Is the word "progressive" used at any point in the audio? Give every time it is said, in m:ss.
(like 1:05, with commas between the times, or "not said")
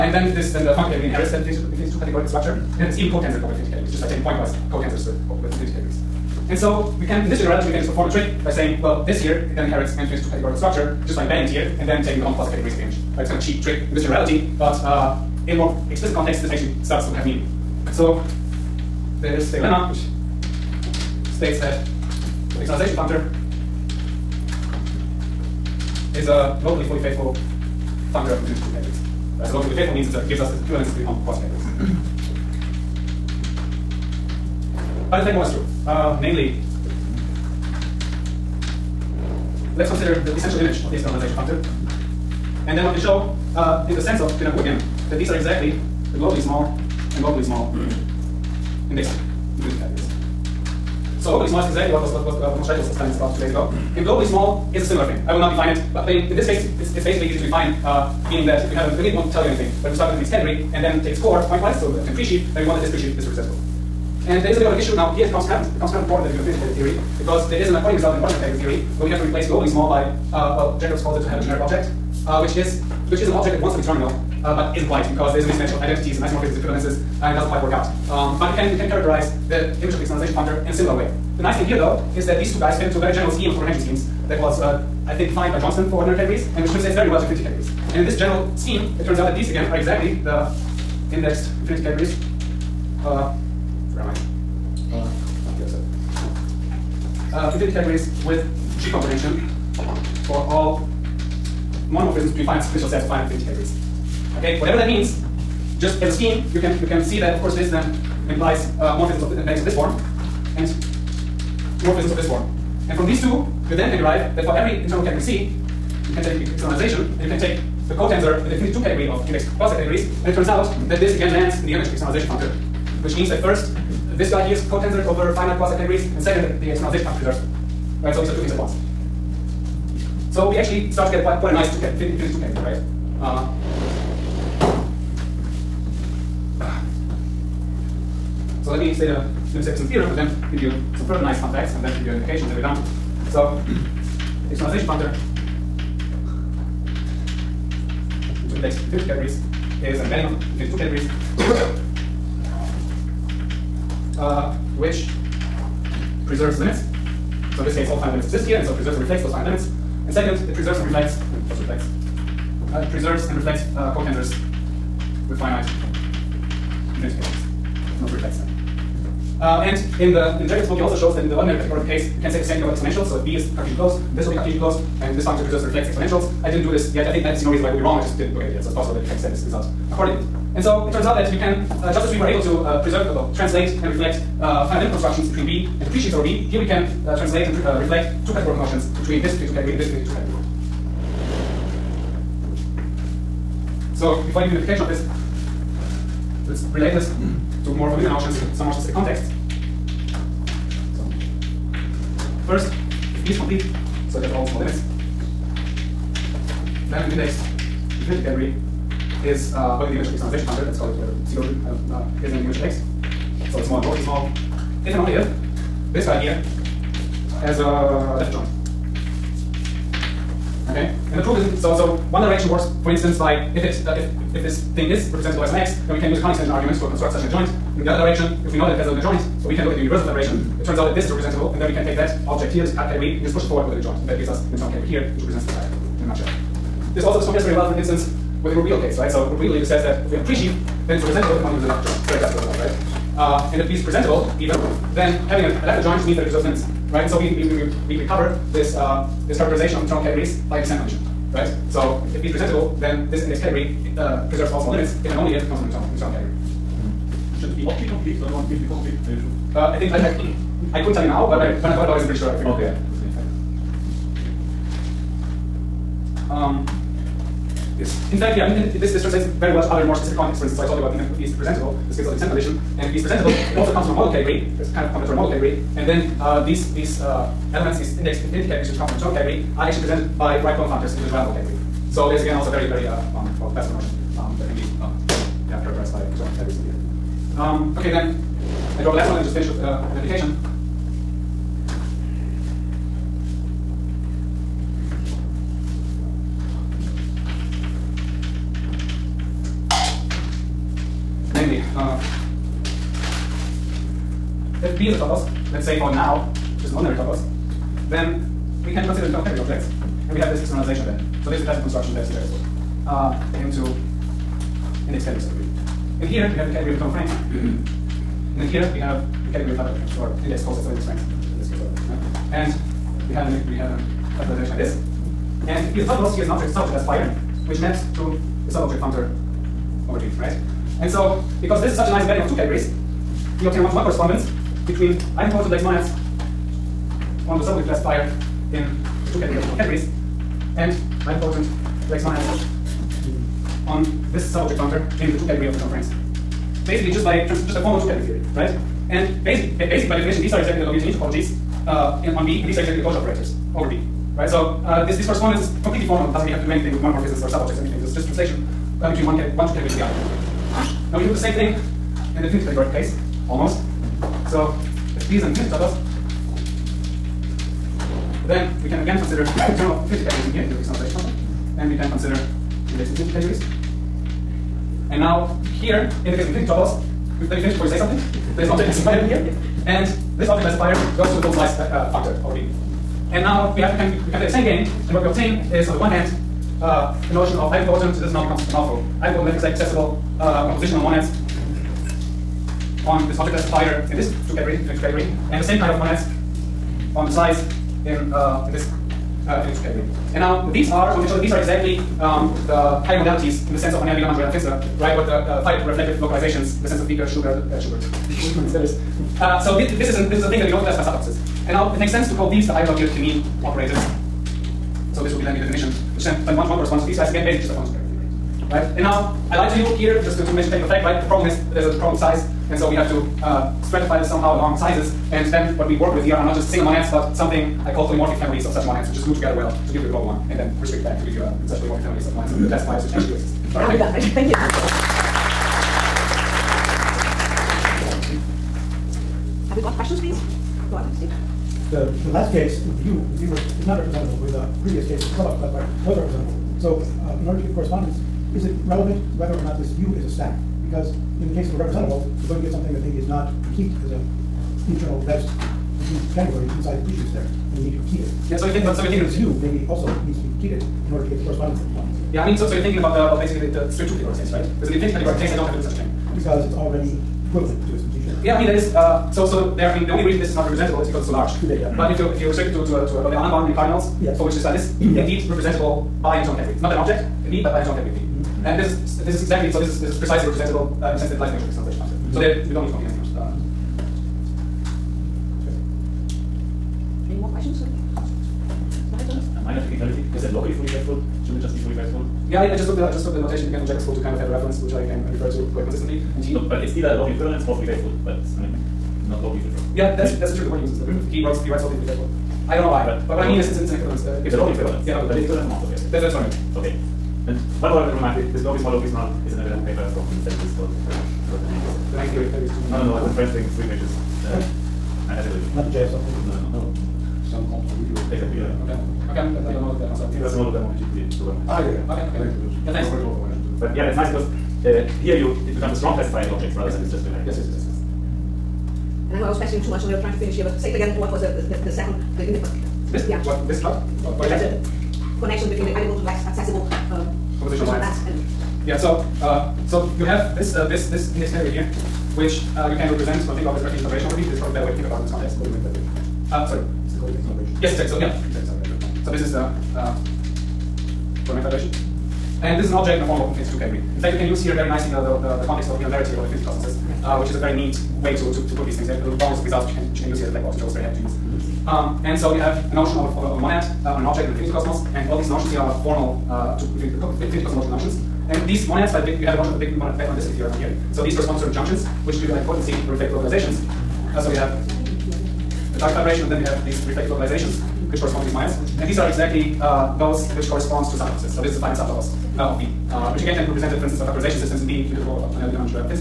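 not said.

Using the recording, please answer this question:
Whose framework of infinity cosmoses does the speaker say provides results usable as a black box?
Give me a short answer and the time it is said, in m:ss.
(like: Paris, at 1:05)
Riehl-Verity, at 9:15.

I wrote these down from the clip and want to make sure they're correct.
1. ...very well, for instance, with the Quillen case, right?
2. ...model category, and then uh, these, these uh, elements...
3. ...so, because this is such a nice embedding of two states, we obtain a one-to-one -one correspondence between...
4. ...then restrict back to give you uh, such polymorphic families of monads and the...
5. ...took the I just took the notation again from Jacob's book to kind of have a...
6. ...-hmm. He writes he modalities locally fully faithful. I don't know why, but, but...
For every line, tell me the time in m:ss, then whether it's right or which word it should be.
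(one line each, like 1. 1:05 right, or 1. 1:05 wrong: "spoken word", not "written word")
1. 3:57 wrong: "Grobedel", not "Quillen"
2. 4:35 right
3. 5:30 wrong: "categories", not "states"
4. 7:10 right
5. 8:12 right
6. 8:20 wrong: "writes", not "modalities".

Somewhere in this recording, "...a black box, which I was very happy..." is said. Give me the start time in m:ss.
9:20.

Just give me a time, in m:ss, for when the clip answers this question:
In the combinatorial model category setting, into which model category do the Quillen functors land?
4:41.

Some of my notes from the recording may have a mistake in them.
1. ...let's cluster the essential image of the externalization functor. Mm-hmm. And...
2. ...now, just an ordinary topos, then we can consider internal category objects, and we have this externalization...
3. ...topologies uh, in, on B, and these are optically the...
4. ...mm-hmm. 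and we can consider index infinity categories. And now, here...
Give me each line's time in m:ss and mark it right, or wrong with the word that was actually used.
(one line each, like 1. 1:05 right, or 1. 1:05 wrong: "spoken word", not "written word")
1. 0:39 wrong: "consider", not "cluster"
2. 5:05 right
3. 5:50 wrong: "exactly", not "optically"
4. 6:11 right.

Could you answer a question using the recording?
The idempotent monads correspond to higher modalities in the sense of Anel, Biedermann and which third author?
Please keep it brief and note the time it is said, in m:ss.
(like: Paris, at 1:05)
Finster, at 6:44.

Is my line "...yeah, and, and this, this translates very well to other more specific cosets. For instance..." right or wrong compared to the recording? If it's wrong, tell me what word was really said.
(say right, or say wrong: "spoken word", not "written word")
wrong: "contexts", not "cosets".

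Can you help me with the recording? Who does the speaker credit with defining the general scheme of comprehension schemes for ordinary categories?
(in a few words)
Johnstone.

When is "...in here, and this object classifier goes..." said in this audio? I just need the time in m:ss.
6:18.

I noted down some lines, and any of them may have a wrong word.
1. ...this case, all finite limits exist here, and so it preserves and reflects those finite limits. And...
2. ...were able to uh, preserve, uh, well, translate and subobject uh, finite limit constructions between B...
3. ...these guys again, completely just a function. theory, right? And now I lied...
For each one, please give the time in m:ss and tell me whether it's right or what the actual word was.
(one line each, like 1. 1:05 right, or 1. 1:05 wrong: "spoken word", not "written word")
1. 2:37 right
2. 3:02 wrong: "reflect", not "subobject"
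3. 6:56 wrong: "basically", not "completely".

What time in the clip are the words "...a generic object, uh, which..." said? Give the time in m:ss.
1:11.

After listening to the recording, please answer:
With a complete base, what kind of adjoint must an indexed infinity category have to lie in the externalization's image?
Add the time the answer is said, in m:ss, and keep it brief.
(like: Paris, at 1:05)
left adjoint, at 3:38.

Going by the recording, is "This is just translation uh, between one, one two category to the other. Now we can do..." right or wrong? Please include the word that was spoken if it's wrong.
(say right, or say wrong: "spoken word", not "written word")
right.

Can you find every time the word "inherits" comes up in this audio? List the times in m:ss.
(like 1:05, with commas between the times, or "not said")
0:01, 0:09.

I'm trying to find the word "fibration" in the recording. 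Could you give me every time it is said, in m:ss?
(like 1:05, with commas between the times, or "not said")
3:50, 9:03, 9:11, 9:35.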